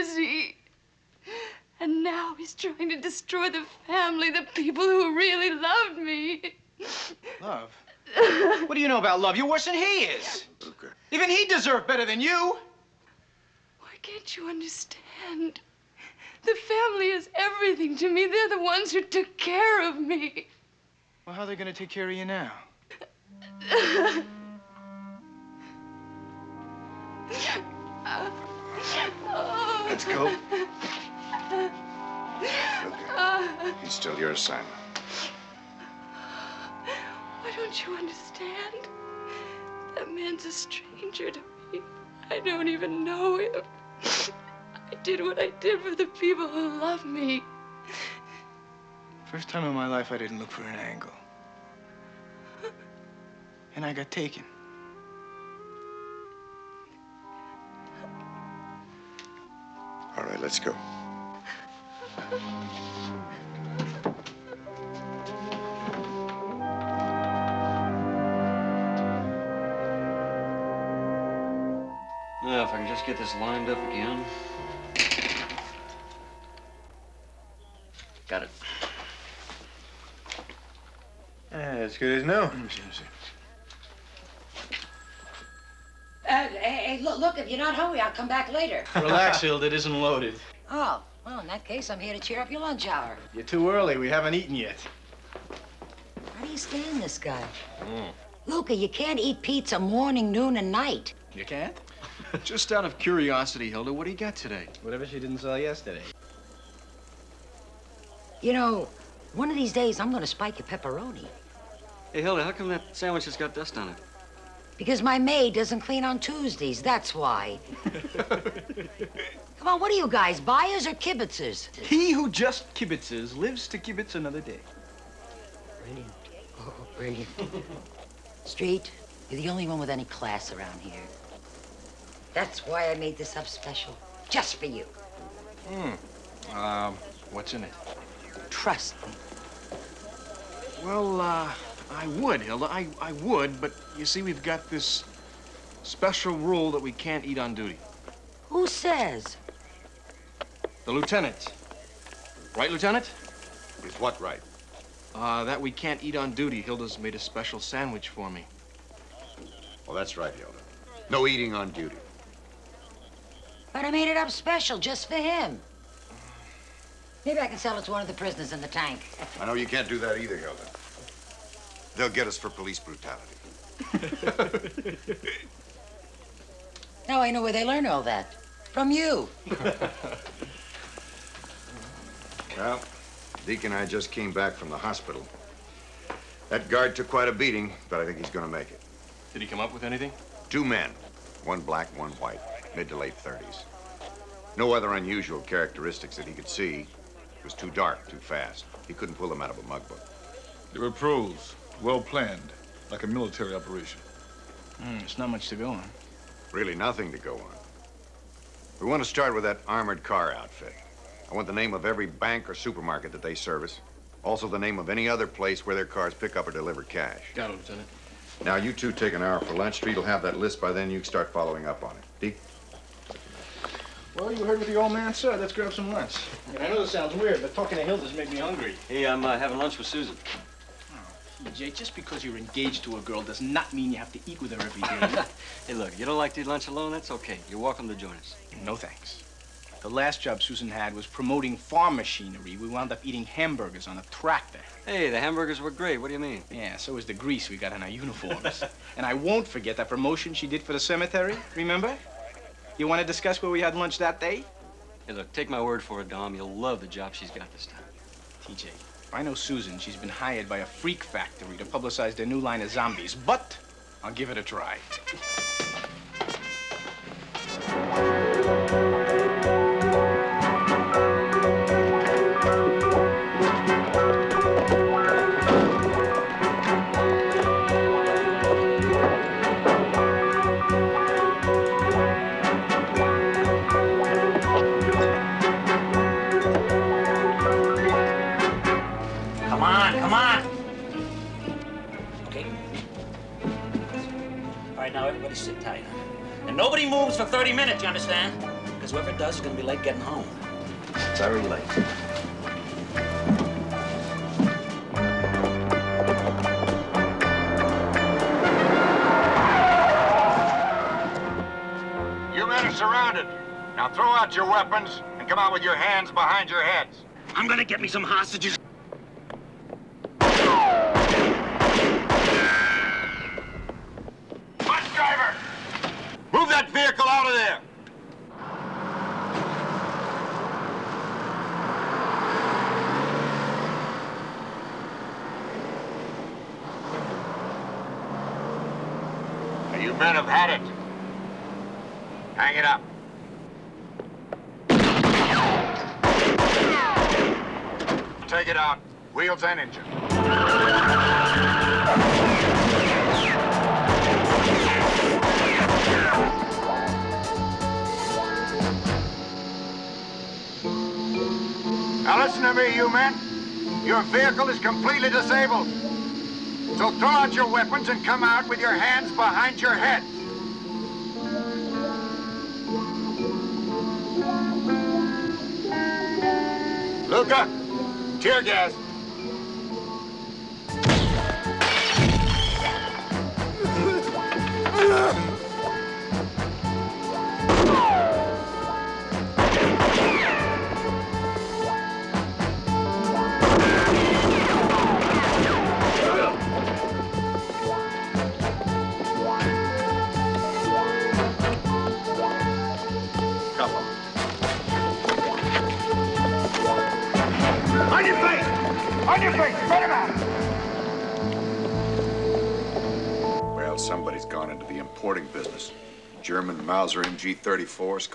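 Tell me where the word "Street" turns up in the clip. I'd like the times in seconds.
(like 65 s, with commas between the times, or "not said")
128 s, 219 s.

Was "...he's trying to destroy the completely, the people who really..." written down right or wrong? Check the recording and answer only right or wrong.
wrong.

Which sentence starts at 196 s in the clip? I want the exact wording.
It was too dark, too fast.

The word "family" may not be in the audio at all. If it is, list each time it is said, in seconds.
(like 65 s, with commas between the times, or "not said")
3 s, 16 s.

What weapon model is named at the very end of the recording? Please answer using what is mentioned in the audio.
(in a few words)
Mauser MG-34.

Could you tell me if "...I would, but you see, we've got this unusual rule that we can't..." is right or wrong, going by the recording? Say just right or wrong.
wrong.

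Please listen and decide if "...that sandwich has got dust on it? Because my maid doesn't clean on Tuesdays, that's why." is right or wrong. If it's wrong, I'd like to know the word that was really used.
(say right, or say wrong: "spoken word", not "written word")
right.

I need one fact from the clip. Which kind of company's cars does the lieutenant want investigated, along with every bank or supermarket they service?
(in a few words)
Armored car outfit.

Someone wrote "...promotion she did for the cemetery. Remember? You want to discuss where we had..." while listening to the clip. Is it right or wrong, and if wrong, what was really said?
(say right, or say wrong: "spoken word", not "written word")
right.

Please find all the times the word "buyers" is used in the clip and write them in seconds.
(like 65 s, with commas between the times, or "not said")
120 s.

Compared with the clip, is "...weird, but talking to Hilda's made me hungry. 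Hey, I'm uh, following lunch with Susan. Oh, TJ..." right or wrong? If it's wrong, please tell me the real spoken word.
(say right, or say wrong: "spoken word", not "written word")
wrong: "having", not "following".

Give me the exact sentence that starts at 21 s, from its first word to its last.
Well, how are they going to take care of you now?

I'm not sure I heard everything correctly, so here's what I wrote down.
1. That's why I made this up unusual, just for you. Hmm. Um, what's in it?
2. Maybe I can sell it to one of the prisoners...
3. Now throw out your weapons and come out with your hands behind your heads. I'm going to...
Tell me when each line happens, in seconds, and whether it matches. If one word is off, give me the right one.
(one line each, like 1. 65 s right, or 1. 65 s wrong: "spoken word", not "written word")
1. 132 s wrong: "special", not "unusual"
2. 167 s right
3. 313 s right.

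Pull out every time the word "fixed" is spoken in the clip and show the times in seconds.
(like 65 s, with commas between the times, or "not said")
not said.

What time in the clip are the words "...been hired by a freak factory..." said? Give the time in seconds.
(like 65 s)
259 s.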